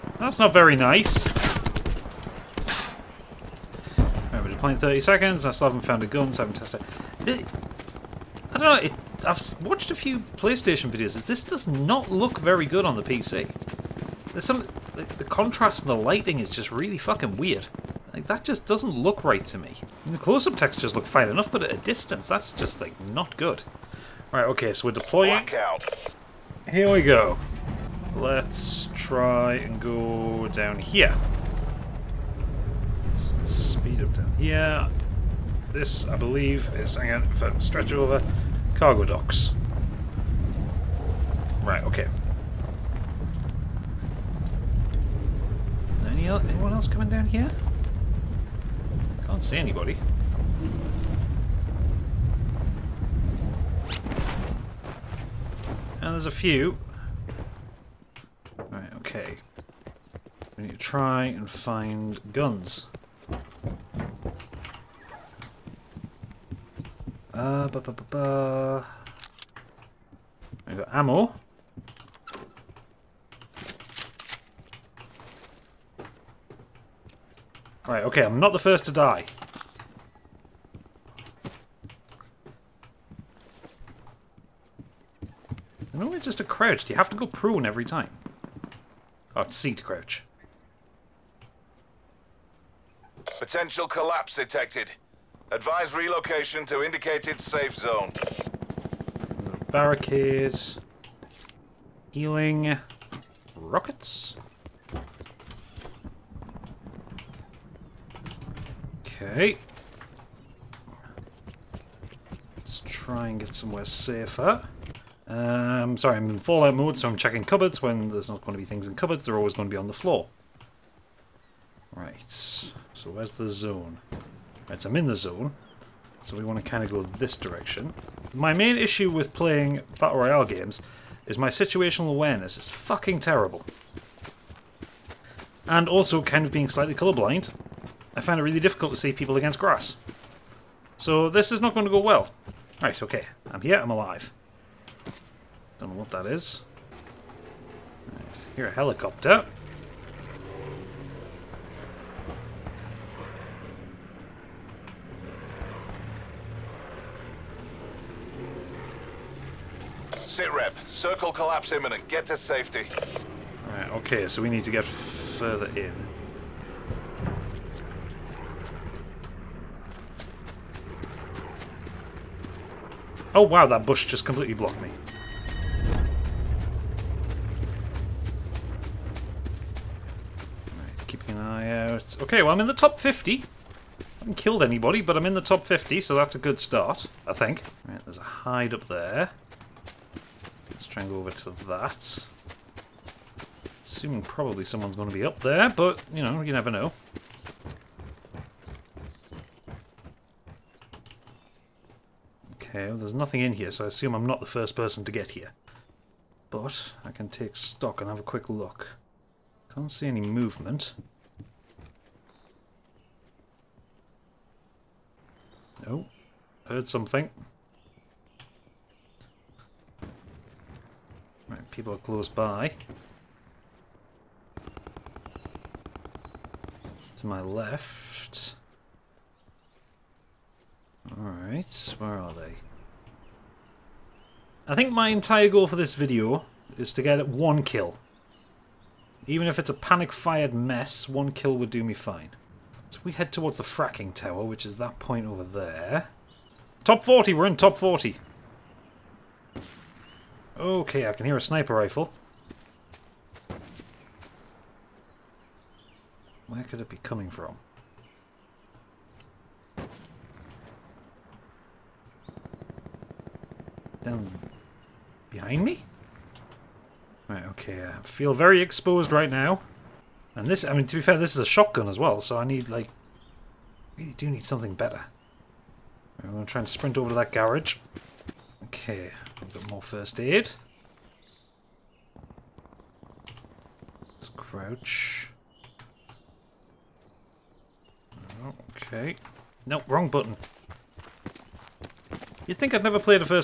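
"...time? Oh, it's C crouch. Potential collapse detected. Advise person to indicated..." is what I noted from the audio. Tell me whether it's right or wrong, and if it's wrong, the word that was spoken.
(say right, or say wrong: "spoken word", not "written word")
wrong: "relocation", not "person".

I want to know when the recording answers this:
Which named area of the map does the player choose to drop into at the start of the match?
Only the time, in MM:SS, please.
00:38.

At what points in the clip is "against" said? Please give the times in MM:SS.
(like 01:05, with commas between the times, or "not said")
02:19.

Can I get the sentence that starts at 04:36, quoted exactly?
I'm going to try and sprint over to that garage.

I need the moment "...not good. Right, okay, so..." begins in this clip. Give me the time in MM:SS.
00:23.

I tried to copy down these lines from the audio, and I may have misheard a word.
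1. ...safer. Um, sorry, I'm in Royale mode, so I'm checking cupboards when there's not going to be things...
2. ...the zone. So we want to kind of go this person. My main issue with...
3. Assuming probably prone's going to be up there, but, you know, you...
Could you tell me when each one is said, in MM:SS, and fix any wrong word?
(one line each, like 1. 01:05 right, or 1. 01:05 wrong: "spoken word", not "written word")
1. 01:53 wrong: "Fallout", not "Royale"
2. 02:05 wrong: "direction", not "person"
3. 03:13 wrong: "someone", not "prone".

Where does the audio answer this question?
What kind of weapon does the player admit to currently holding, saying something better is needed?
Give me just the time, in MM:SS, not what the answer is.
04:31.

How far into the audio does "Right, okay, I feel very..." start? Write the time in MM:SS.
04:27.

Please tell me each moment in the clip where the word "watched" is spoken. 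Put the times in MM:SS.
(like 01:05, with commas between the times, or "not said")
00:09.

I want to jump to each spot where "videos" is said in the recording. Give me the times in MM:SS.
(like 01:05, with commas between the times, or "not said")
00:10, 03:55.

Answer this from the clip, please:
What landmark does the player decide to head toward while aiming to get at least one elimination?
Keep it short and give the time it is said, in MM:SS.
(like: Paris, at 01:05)
Fracking tower, at 04:03.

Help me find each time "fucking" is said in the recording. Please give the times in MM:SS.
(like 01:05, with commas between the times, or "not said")
00:16, 02:12.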